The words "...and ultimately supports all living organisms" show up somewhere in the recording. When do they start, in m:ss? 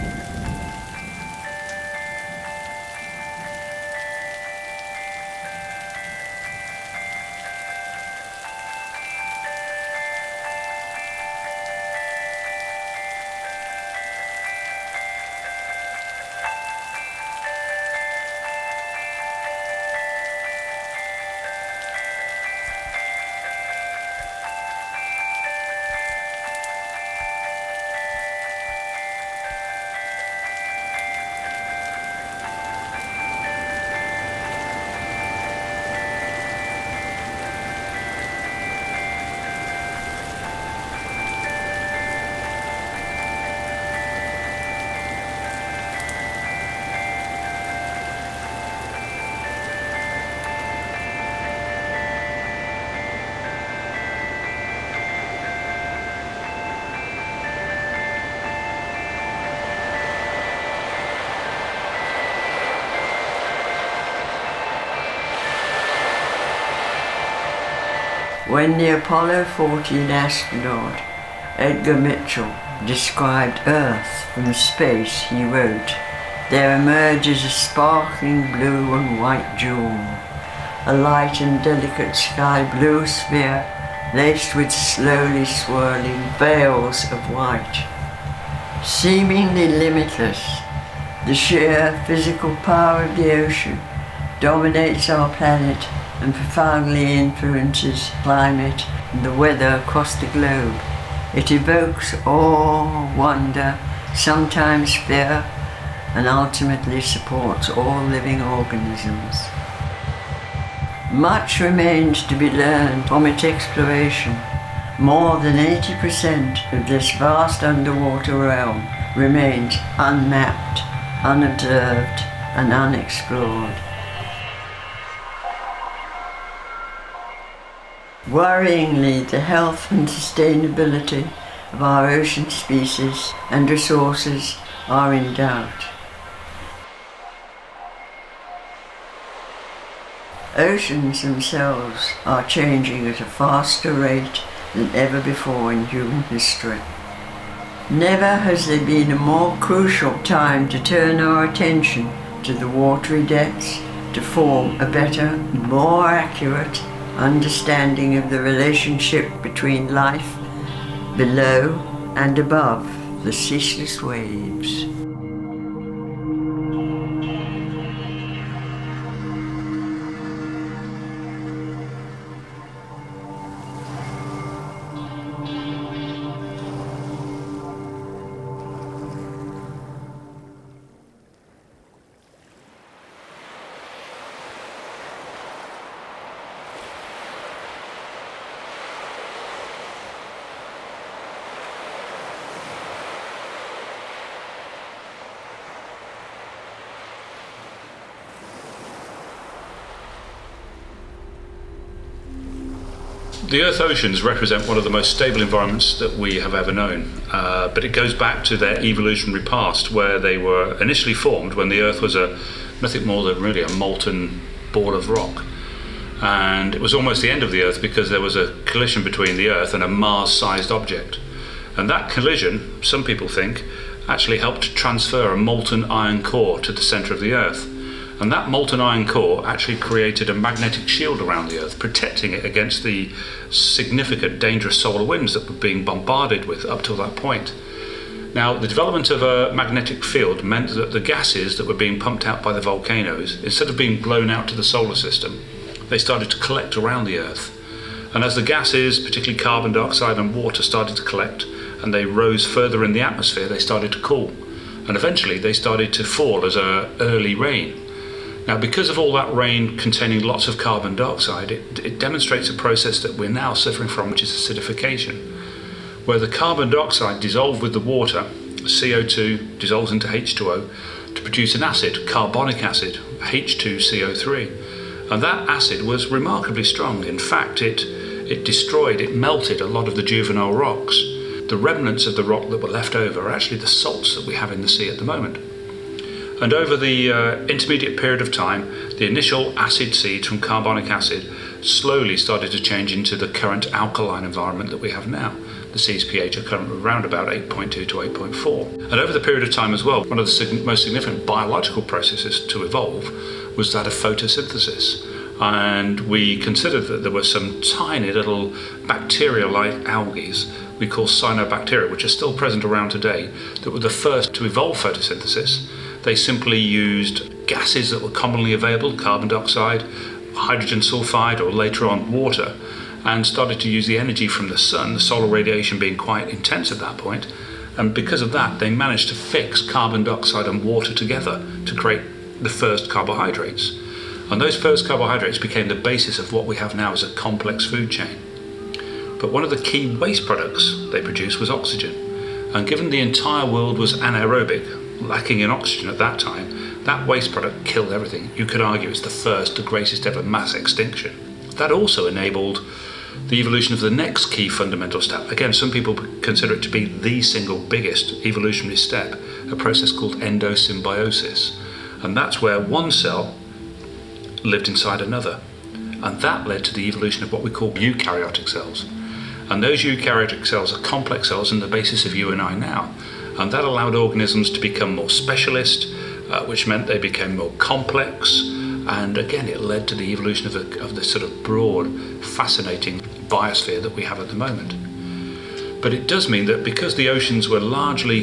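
1:46.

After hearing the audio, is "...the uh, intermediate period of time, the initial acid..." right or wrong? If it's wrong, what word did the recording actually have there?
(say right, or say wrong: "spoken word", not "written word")
right.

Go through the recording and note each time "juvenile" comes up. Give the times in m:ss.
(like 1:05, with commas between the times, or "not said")
4:40.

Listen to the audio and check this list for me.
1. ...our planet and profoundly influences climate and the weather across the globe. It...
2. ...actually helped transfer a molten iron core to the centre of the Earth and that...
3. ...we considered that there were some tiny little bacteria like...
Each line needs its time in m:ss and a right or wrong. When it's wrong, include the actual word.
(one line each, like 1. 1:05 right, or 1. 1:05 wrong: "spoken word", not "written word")
1. 1:35 right
2. 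3:44 right
3. 5:06 right.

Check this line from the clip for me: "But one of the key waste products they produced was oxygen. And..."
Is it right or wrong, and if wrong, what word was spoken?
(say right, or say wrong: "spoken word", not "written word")
right.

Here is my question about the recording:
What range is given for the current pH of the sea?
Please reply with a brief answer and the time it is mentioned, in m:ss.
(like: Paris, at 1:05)
8.2 to 8.4, at 4:57.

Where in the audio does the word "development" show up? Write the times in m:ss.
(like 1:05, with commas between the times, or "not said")
3:58.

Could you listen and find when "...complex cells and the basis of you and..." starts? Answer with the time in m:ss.
6:10.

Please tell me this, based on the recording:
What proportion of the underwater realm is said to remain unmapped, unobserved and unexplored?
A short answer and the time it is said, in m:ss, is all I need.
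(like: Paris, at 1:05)
More than 80%, at 1:54.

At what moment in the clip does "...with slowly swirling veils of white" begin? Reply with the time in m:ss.
1:24.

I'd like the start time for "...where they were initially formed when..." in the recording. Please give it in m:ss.
3:29.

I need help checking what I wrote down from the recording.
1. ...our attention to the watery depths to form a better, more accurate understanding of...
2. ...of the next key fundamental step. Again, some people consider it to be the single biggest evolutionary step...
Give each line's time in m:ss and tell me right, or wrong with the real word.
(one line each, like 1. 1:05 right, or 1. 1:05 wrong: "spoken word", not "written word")
1. 2:31 right
2. 5:53 right.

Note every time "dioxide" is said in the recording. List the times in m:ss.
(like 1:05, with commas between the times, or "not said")
4:09, 4:20, 4:26, 5:19, 5:30.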